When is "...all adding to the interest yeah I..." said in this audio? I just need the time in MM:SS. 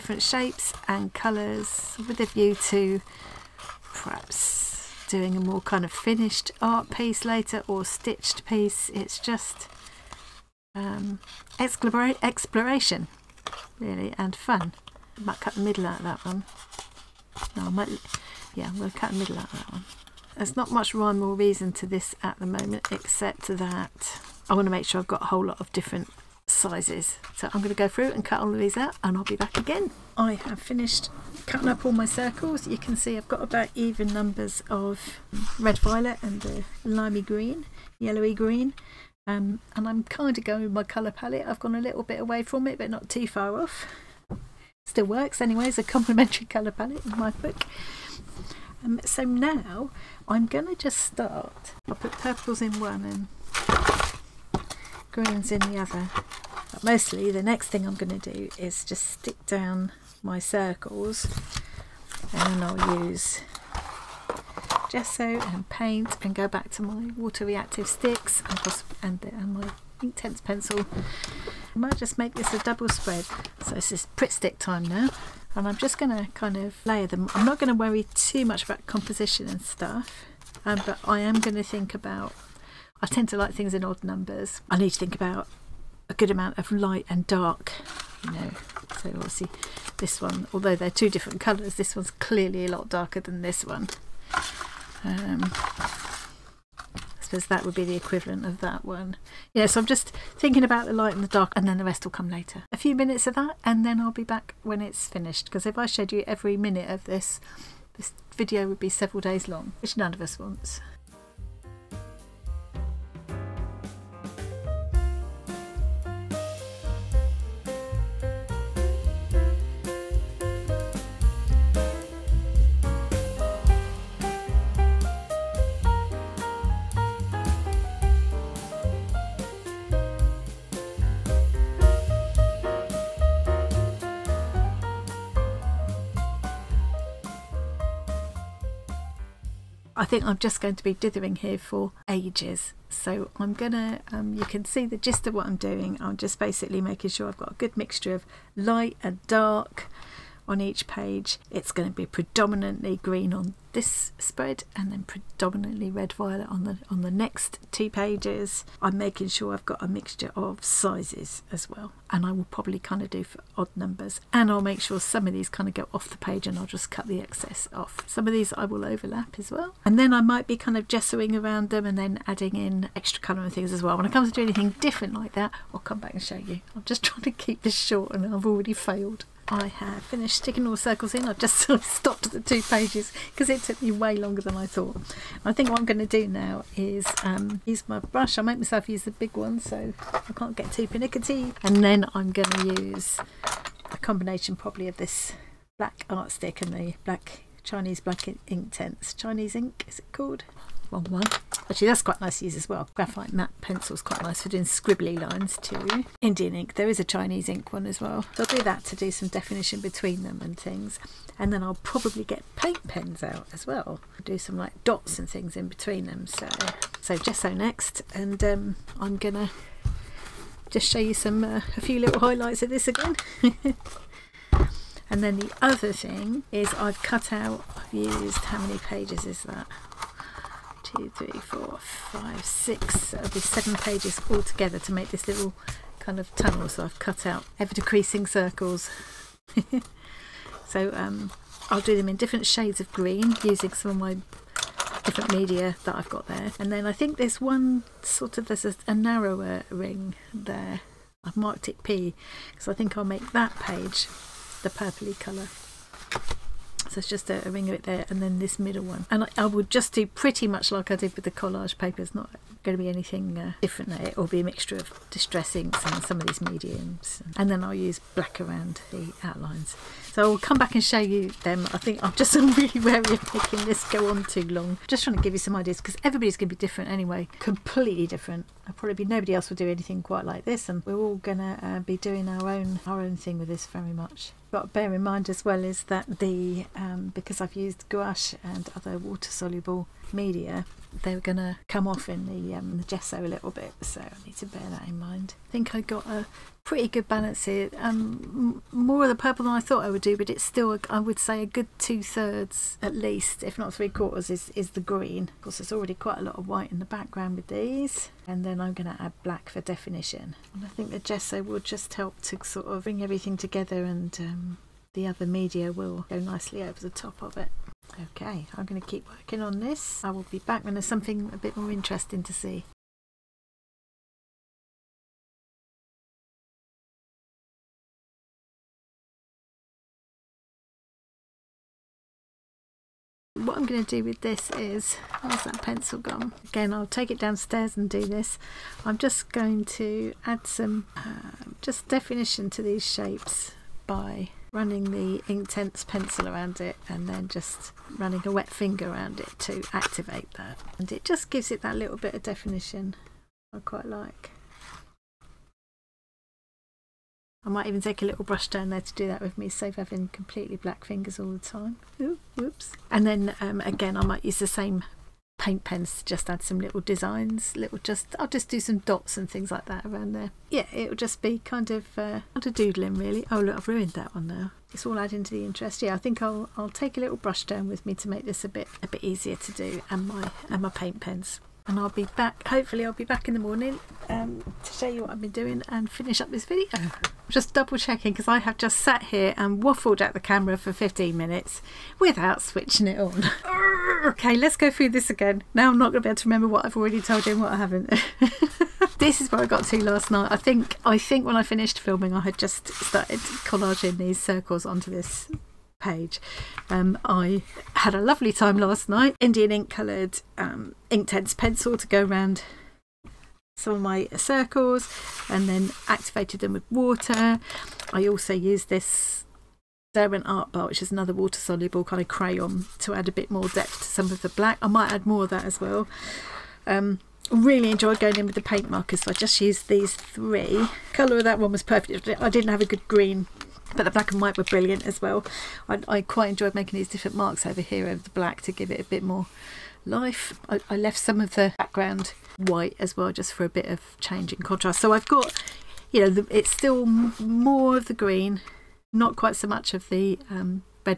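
06:14.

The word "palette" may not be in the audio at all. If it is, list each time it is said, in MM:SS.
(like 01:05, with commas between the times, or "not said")
00:41, 00:46.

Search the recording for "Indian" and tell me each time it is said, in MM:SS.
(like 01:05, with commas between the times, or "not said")
03:26, 06:49.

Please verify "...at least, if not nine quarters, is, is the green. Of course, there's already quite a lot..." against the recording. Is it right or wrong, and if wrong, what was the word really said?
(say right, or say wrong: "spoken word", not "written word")
wrong: "three", not "nine".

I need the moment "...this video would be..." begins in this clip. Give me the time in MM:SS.
01:47.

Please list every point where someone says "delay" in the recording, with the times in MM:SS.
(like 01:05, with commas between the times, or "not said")
not said.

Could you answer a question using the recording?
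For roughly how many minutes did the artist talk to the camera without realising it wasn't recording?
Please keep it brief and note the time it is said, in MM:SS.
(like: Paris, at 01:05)
15, at 06:30.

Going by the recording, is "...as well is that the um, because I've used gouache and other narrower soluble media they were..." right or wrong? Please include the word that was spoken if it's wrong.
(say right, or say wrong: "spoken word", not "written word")
wrong: "water", not "narrower".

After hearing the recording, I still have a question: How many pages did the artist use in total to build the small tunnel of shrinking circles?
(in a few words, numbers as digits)
7.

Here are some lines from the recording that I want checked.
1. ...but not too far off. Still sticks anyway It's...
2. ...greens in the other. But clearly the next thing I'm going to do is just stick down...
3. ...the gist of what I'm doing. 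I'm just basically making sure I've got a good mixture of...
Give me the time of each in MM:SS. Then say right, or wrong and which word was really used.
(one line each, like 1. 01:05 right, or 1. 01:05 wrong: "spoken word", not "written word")
1. 00:42 wrong: "works", not "sticks"
2. 00:55 wrong: "mostly", not "clearly"
3. 02:24 right.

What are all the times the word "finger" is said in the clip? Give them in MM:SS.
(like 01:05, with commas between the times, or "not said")
05:48, 06:00.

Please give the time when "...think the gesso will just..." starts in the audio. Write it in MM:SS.
05:10.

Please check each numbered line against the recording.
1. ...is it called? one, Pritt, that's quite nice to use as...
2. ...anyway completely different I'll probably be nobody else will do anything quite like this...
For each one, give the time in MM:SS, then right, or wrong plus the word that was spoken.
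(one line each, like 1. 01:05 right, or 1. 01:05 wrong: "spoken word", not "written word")
1. 03:19 wrong: "Actually", not "Pritt"
2. 04:36 right.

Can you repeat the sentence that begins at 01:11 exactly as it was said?
I might just make this a double spread.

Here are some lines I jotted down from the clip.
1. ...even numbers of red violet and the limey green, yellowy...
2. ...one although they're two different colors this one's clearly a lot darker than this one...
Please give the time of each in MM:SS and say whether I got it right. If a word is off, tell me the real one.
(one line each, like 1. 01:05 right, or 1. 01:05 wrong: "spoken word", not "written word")
1. 00:33 right
2. 01:30 right.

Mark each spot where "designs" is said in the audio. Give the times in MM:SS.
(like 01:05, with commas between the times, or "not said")
06:06.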